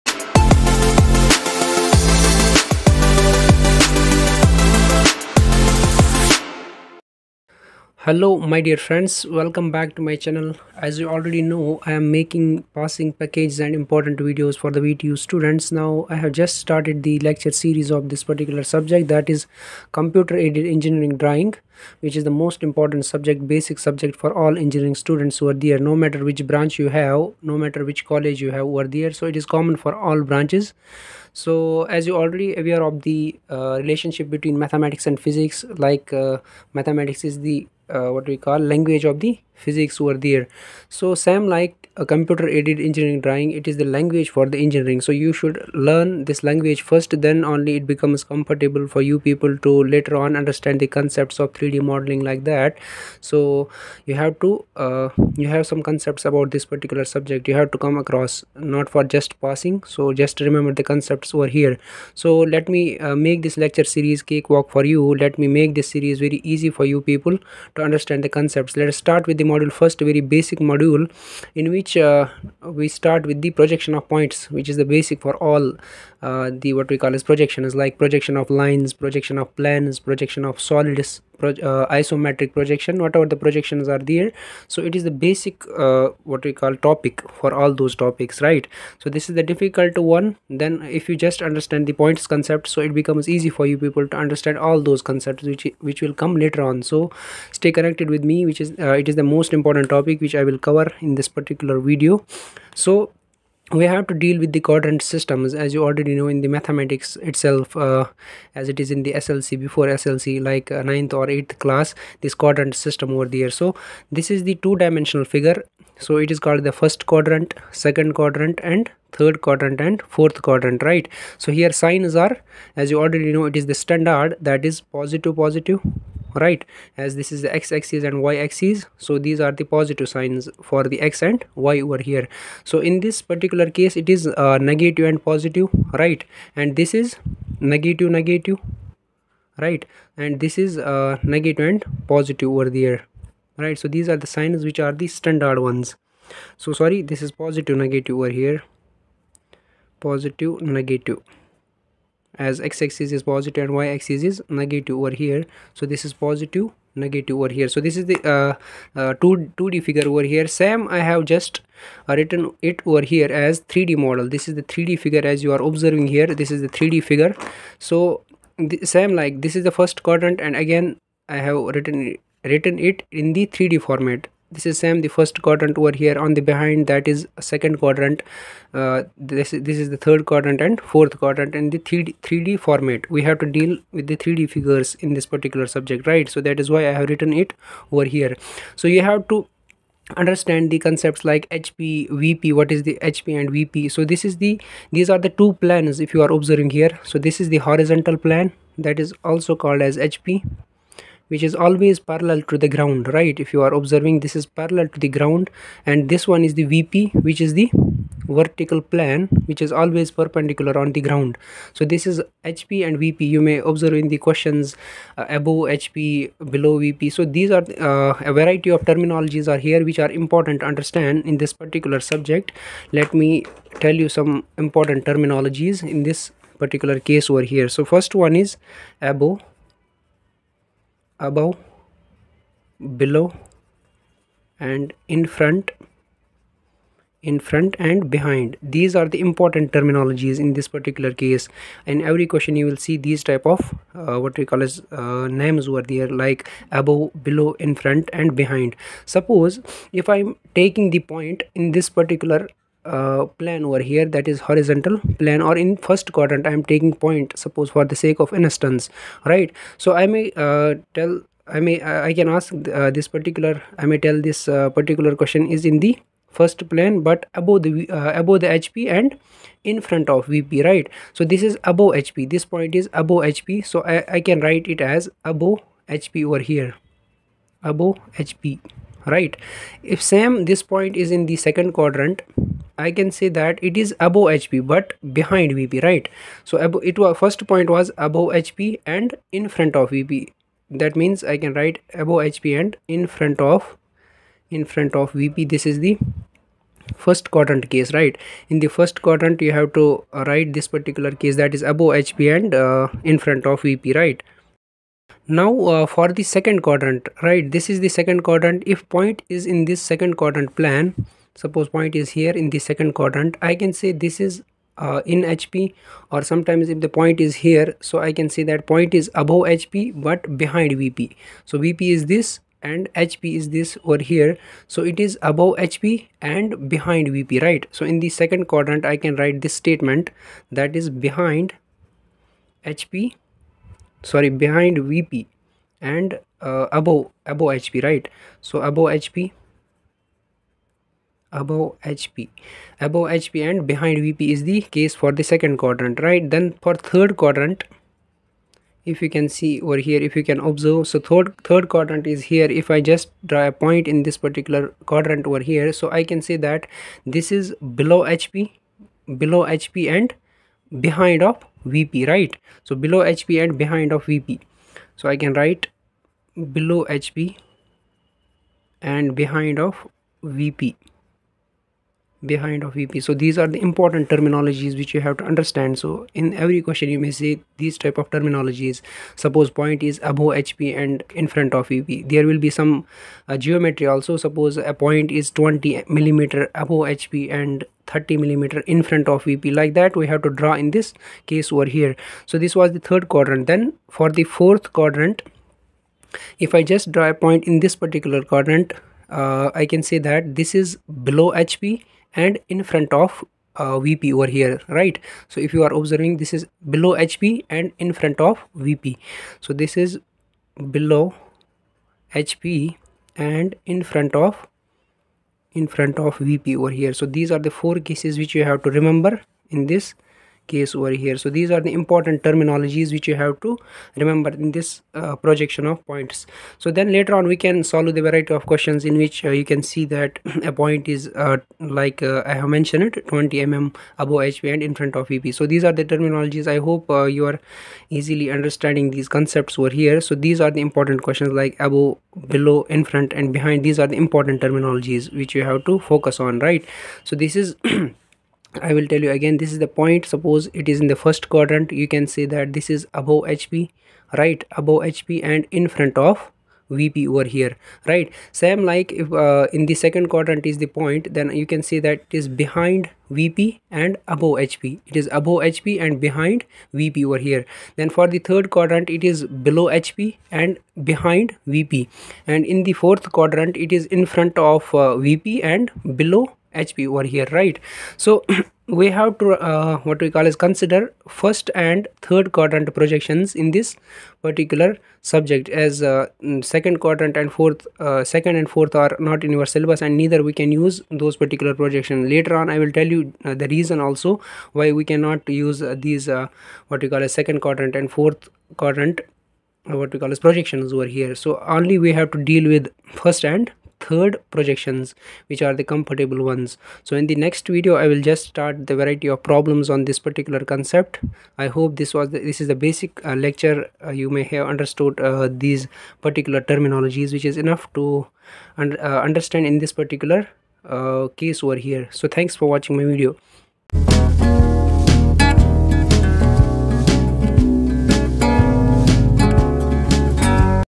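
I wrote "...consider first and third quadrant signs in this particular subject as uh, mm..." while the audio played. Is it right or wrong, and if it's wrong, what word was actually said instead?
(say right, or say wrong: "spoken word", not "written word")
wrong: "projections", not "signs".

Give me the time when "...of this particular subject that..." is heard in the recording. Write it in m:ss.
0:17.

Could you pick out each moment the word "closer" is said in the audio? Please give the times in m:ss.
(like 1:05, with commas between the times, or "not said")
not said.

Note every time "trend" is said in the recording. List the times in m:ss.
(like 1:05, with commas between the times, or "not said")
not said.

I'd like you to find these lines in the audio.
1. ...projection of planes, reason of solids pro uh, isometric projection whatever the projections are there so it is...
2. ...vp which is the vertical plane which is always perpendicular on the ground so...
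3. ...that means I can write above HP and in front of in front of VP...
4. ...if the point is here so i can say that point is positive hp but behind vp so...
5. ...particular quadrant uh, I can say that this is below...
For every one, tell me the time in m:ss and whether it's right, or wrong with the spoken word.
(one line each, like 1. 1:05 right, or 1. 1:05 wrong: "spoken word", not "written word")
1. 1:18 wrong: "projection", not "reason"
2. 3:26 right
3. 4:50 right
4. 5:16 wrong: "above", not "positive"
5. 6:37 right.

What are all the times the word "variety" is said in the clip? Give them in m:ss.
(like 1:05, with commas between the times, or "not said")
3:38, 7:08, 8:28.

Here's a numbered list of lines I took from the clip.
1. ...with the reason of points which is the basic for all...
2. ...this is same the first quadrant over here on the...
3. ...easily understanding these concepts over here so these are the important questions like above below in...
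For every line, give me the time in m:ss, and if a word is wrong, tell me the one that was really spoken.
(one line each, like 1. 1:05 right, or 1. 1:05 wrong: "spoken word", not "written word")
1. 1:13 wrong: "projection", not "reason"
2. 2:54 right
3. 7:17 right.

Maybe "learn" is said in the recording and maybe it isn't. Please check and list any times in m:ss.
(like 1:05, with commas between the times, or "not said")
0:45.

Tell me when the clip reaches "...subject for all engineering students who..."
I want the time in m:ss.
0:23.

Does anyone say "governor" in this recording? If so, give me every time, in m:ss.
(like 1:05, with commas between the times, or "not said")
not said.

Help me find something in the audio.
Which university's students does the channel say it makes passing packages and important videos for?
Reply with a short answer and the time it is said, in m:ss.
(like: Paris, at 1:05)
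VTU, at 0:14.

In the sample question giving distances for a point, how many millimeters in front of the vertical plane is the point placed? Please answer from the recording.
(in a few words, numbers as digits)
30 mm.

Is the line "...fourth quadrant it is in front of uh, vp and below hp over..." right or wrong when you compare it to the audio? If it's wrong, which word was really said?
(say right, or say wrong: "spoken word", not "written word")
right.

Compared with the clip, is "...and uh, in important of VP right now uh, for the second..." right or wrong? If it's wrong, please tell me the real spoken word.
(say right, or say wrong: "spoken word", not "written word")
wrong: "front", not "important".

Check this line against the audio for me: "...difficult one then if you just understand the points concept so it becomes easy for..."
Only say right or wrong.
right.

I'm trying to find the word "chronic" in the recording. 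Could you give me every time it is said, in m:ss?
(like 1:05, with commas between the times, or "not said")
not said.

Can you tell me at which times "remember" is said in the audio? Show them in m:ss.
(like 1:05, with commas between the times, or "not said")
1:00, 6:58, 7:03.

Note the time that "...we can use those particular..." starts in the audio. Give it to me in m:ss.
8:10.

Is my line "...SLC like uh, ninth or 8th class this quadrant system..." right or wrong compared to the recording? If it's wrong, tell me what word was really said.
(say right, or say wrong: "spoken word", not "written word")
right.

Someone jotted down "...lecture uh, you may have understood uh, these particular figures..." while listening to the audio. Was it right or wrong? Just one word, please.
wrong.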